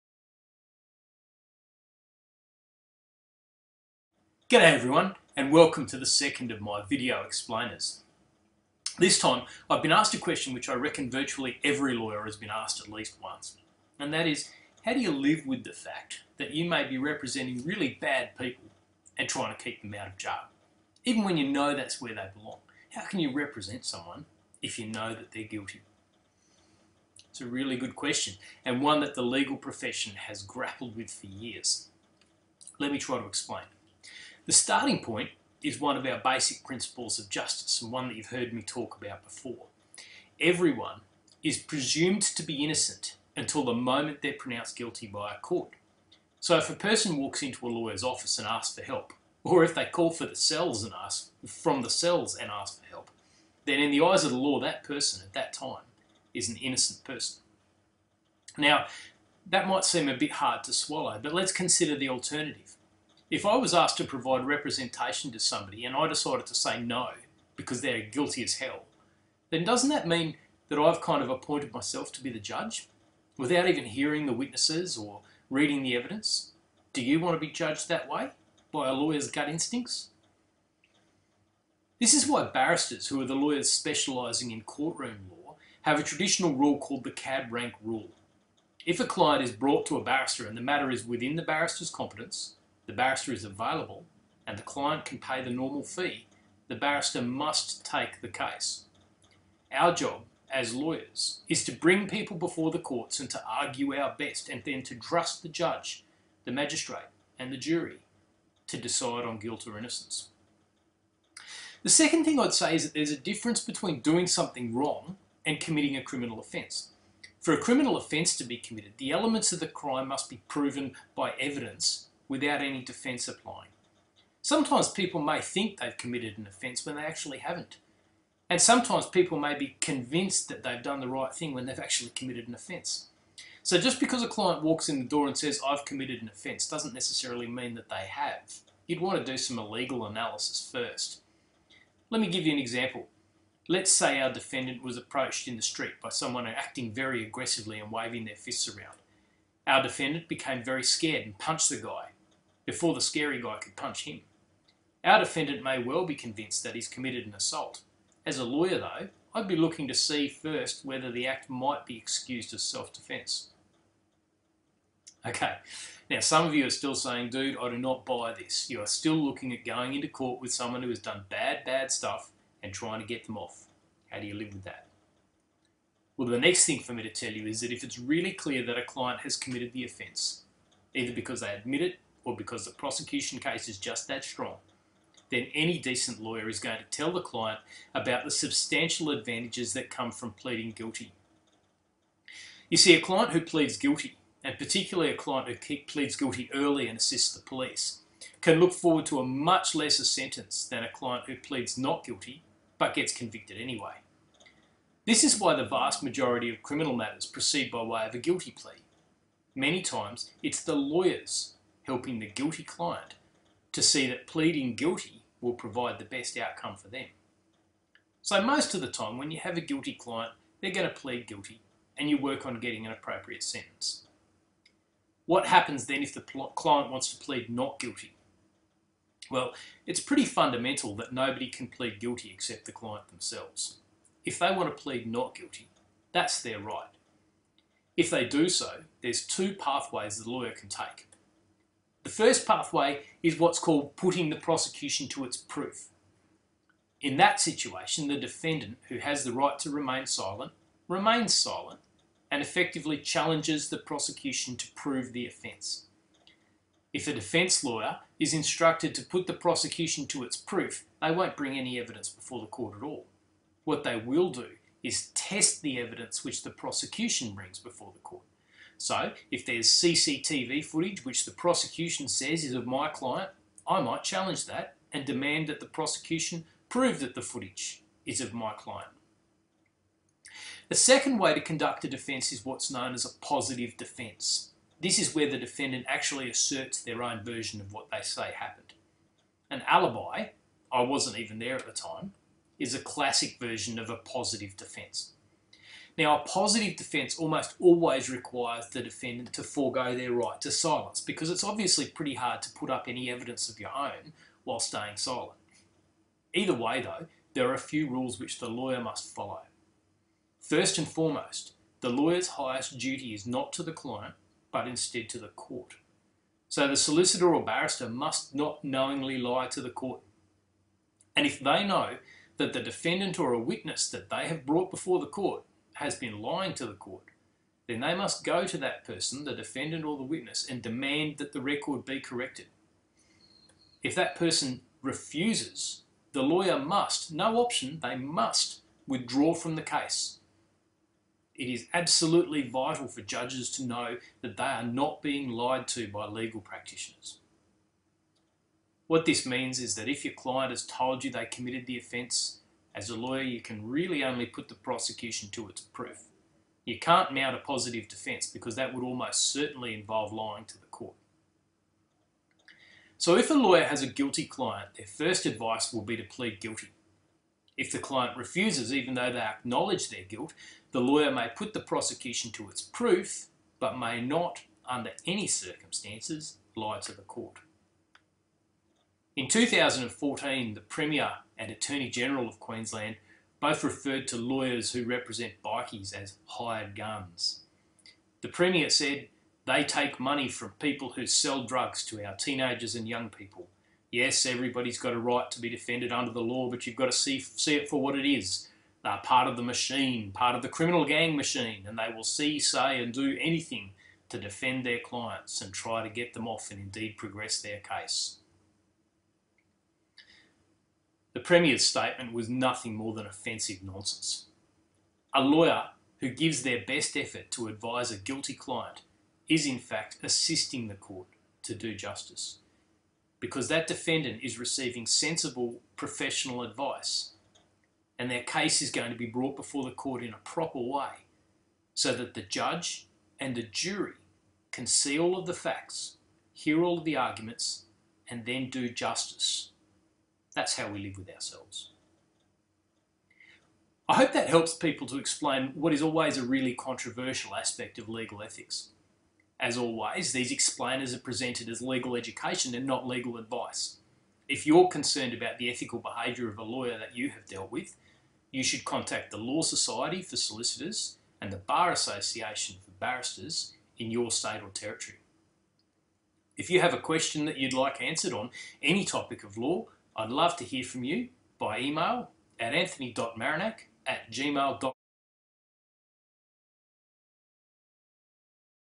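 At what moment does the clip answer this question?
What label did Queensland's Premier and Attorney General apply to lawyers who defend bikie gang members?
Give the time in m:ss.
6:26.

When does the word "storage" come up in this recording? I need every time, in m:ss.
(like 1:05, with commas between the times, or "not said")
not said.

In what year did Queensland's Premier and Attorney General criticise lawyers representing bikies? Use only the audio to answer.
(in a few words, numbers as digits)
2014.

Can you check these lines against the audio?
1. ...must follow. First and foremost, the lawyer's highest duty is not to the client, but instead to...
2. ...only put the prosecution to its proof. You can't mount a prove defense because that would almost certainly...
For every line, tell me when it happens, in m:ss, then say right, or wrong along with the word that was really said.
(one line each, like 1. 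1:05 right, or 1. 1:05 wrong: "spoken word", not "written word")
1. 5:08 right
2. 5:54 wrong: "positive", not "prove".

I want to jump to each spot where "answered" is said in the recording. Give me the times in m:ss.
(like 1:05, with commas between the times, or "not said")
7:47.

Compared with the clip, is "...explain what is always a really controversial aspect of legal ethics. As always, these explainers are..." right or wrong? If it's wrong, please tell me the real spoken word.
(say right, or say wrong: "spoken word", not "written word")
right.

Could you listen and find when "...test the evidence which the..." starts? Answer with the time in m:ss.
4:25.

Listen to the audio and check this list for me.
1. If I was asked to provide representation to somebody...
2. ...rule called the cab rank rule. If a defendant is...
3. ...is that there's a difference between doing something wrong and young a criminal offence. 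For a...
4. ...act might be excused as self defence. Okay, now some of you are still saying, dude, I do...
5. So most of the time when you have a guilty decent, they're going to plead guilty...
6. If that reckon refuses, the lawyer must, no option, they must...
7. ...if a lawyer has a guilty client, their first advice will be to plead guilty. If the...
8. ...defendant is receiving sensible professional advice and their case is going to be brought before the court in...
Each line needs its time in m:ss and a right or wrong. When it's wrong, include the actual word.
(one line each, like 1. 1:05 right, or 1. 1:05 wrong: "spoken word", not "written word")
1. 1:03 right
2. 1:26 wrong: "client", not "defendant"
3. 1:52 wrong: "committing", not "young"
4. 2:41 right
5. 3:38 wrong: "client", not "decent"
6. 5:33 wrong: "person", not "reckon"
7. 6:03 right
8. 7:03 right.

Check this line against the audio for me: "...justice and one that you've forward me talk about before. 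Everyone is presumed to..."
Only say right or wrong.
wrong.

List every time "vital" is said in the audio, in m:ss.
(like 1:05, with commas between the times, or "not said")
5:42.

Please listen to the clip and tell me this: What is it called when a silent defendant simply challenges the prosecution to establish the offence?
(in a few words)
putting the prosecution to its proof.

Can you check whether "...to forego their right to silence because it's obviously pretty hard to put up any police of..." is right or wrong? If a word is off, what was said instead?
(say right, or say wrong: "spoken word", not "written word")
wrong: "evidence", not "police".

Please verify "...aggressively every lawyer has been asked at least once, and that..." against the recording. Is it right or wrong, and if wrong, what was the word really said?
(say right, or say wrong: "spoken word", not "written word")
wrong: "virtually", not "aggressively".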